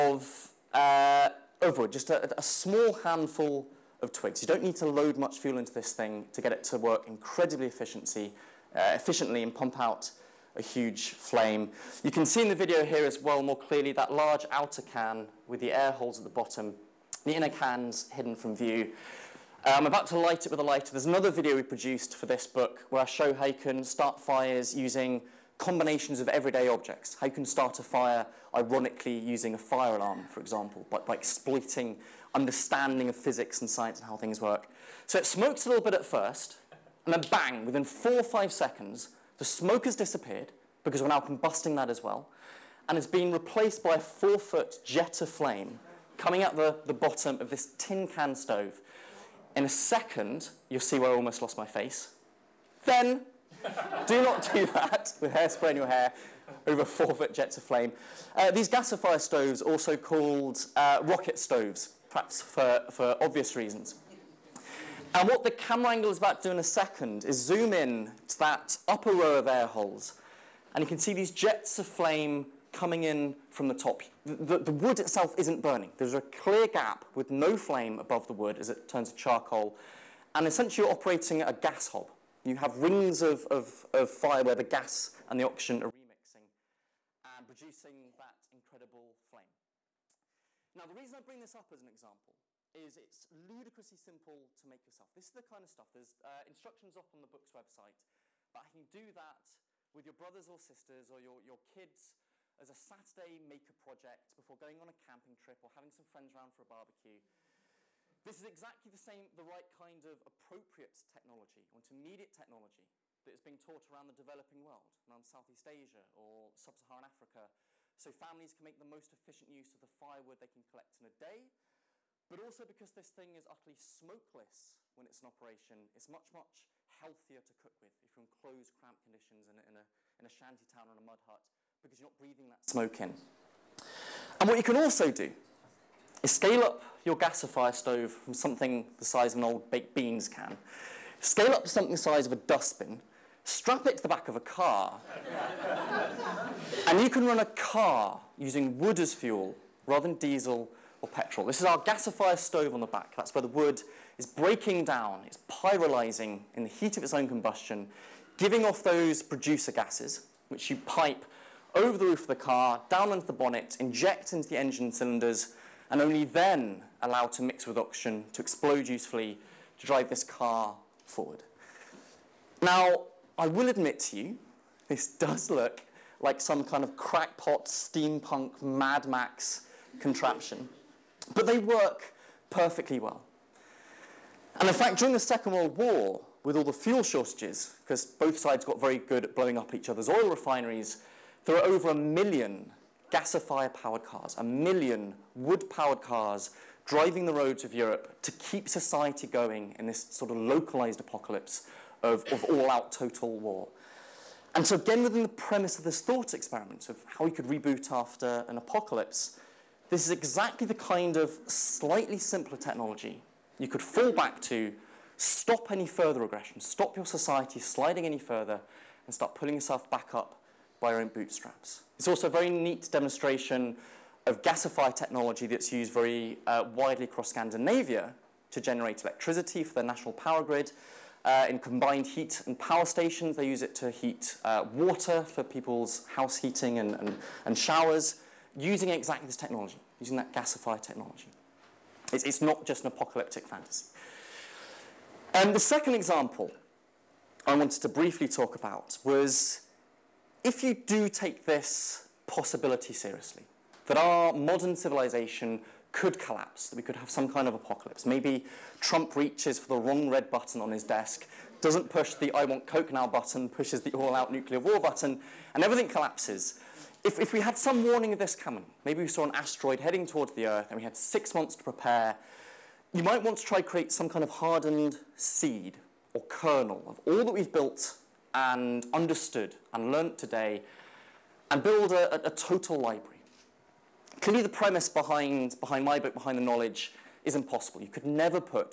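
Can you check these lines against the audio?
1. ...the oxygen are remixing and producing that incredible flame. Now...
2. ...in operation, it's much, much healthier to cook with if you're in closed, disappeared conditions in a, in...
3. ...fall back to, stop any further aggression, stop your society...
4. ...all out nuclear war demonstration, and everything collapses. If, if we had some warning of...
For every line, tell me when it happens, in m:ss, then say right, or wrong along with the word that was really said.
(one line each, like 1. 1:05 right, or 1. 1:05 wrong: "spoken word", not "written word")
1. 1:25 right
2. 2:05 wrong: "cramped", not "disappeared"
3. 3:33 right
4. 4:23 wrong: "button", not "demonstration".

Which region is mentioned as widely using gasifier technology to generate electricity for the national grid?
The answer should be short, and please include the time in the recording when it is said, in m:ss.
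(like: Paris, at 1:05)
Scandinavia, at 3:47.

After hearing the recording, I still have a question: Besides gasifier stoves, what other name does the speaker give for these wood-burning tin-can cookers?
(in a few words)
rocket stoves.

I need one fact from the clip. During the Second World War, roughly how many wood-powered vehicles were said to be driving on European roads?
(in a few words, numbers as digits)
over 1 million.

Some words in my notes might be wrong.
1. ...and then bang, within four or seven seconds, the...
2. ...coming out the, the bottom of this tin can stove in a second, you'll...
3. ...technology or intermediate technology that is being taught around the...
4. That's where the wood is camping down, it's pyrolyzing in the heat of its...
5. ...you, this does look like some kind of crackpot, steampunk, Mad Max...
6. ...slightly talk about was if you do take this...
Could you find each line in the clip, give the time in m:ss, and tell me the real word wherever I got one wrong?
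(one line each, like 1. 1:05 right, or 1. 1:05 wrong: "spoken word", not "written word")
1. 0:37 wrong: "five", not "seven"
2. 0:46 right
3. 1:51 right
4. 2:33 wrong: "breaking", not "camping"
5. 2:54 right
6. 4:07 wrong: "briefly", not "slightly".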